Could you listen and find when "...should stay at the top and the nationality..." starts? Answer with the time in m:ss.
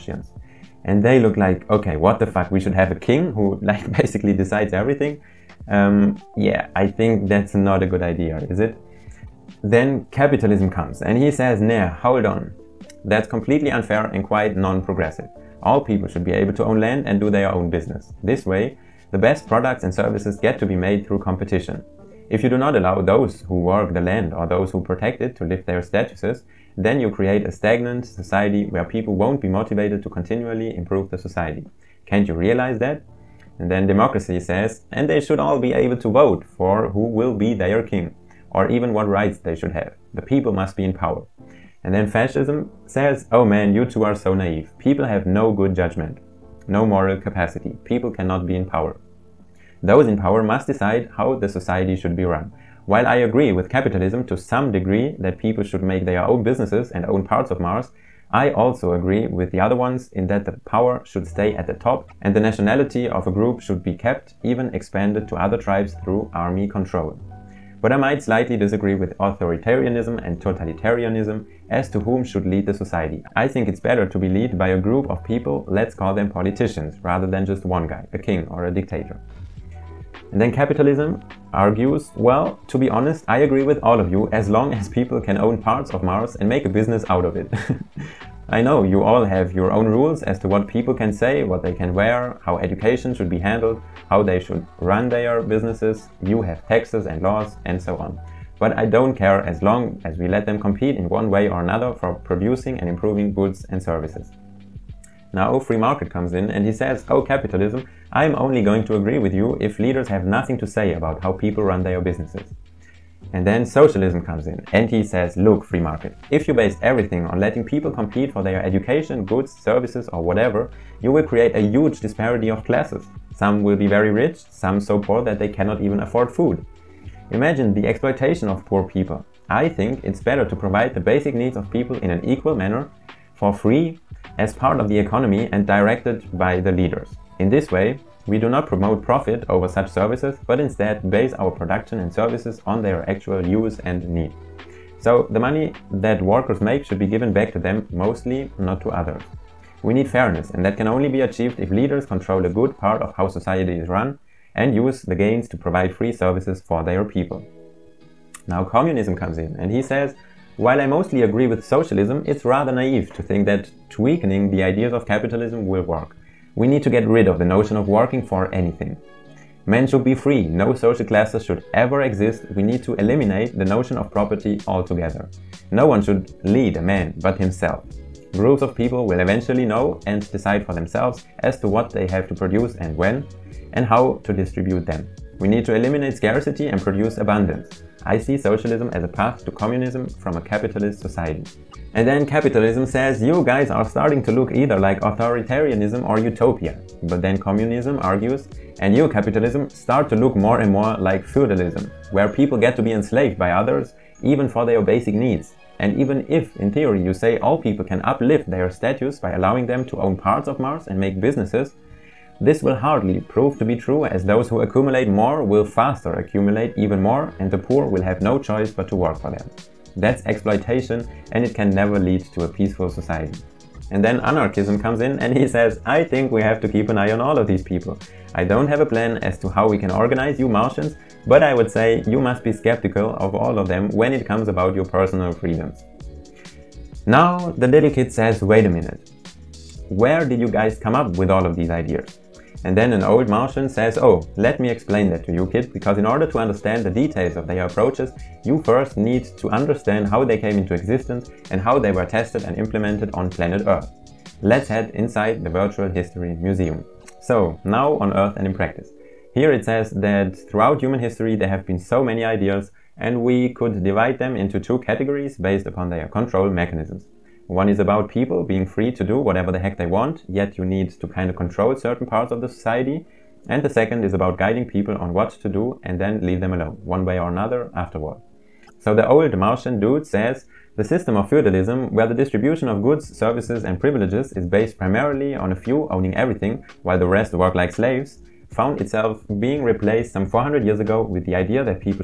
1:01.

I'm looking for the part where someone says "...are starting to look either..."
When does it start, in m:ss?
3:13.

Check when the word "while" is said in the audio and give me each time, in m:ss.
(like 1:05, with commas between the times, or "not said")
0:52, 2:40, 4:46.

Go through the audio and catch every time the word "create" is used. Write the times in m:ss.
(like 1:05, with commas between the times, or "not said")
0:27, 2:01.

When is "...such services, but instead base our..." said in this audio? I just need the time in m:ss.
2:19.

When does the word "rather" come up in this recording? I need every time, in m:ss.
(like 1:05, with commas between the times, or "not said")
1:17, 2:42.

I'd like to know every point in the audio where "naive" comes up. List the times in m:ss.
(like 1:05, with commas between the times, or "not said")
0:44, 2:42.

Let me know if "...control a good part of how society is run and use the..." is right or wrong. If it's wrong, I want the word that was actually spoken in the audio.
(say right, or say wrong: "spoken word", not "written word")
right.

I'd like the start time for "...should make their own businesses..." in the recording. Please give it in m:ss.
0:55.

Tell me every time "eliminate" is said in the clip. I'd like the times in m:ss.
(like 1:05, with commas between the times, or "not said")
2:52, 3:05.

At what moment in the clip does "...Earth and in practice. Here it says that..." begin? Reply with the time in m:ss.
4:18.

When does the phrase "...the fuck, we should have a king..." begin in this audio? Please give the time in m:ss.
0:02.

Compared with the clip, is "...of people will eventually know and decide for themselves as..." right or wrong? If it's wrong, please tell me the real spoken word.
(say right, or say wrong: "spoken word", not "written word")
right.